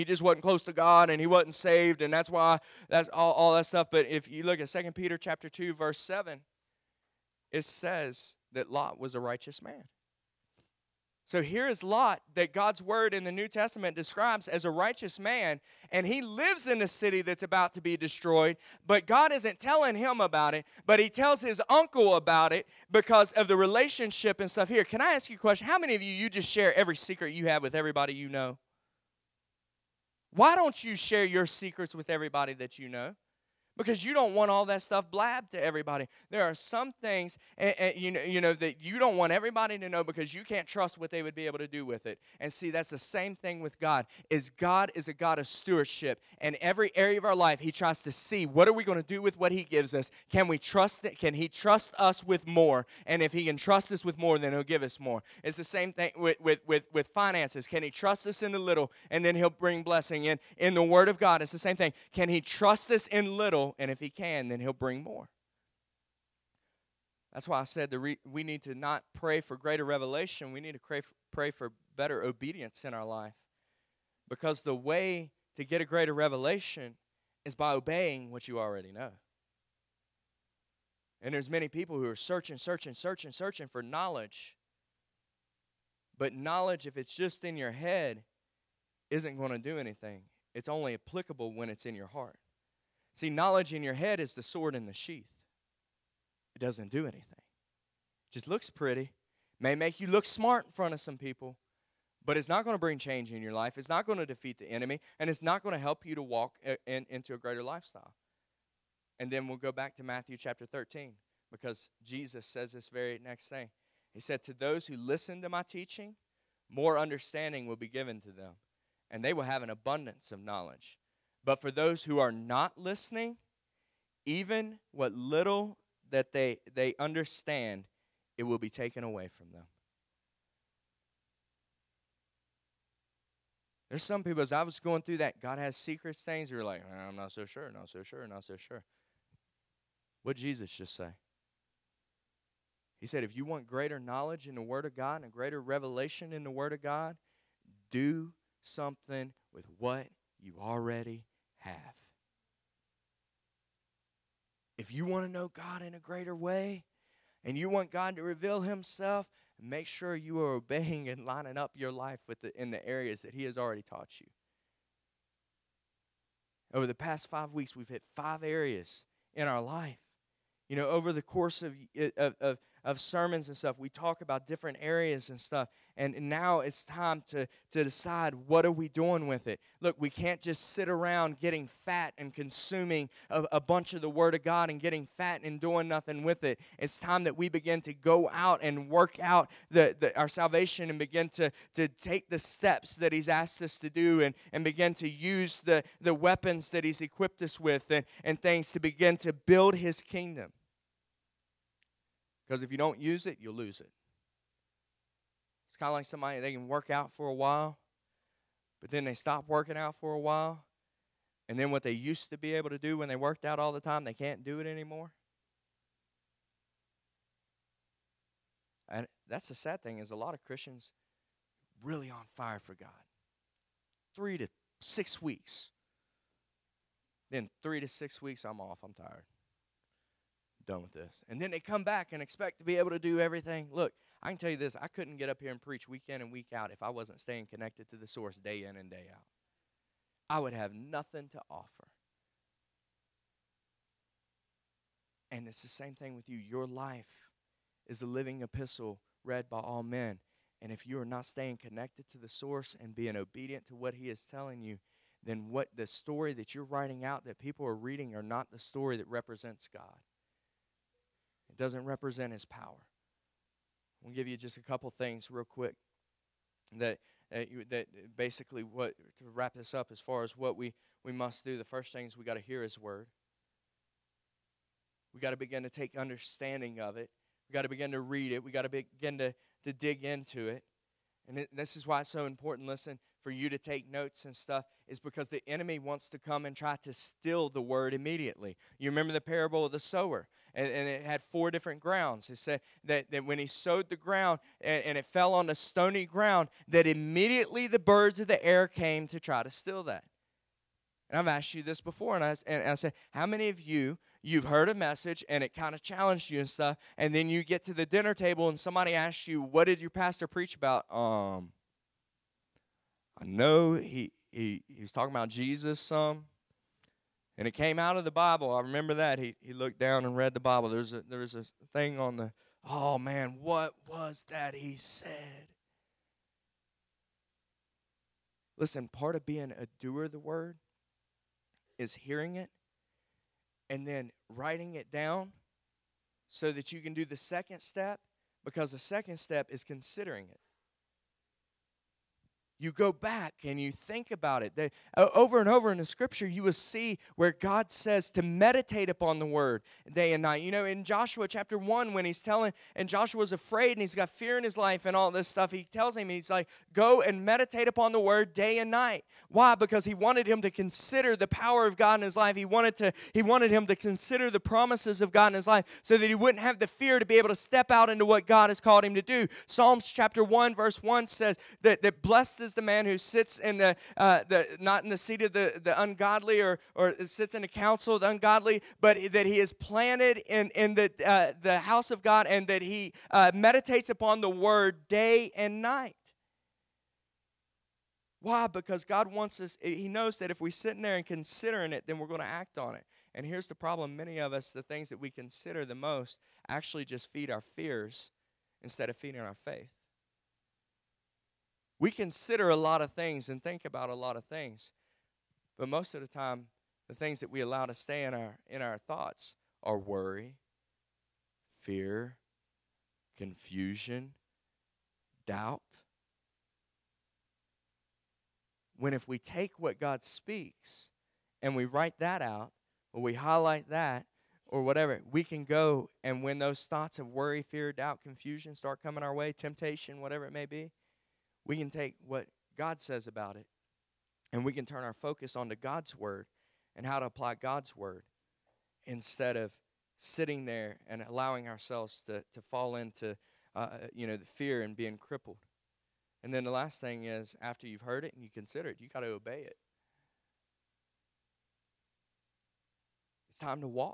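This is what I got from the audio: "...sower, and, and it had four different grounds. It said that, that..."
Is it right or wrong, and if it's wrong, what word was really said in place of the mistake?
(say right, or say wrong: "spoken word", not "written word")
right.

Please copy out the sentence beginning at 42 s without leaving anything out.
And see, that's the same thing with God.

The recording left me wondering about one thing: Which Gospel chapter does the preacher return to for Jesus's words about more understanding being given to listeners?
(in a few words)
Matthew 13.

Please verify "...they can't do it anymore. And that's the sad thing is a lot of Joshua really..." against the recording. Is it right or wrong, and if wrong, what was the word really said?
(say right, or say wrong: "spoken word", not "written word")
wrong: "Christians", not "Joshua".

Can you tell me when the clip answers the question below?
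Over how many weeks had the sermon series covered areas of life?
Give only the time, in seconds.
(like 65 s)
167 s.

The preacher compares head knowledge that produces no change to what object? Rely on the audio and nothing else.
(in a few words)
Sword in the sheath.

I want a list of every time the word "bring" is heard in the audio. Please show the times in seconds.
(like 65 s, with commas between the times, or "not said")
59 s, 64 s, 102 s.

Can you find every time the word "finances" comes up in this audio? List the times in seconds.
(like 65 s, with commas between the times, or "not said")
57 s.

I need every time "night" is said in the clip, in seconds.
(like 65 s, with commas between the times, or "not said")
350 s, 358 s, 385 s.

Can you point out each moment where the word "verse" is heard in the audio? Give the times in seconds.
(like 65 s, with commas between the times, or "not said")
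5 s, 370 s.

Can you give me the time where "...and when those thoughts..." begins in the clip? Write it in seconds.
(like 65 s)
426 s.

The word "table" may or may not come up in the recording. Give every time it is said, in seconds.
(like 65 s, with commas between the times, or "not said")
308 s.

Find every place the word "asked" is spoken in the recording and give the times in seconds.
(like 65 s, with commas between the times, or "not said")
193 s, 301 s.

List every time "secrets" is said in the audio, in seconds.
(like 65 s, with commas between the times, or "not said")
26 s, 31 s, 135 s.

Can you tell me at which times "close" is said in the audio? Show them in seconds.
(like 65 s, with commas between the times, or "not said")
0 s.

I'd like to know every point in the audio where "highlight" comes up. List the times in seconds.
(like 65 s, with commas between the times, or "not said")
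423 s.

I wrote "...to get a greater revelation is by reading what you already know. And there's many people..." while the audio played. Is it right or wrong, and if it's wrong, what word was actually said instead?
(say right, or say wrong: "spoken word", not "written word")
wrong: "obeying", not "reading".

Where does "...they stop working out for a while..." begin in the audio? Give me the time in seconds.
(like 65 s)
209 s.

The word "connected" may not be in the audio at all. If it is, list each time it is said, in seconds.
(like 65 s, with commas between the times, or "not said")
237 s, 251 s.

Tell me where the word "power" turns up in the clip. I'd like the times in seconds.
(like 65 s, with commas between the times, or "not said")
262 s, 361 s.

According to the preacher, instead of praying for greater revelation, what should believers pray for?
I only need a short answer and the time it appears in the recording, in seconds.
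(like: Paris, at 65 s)
Better obedience, at 71 s.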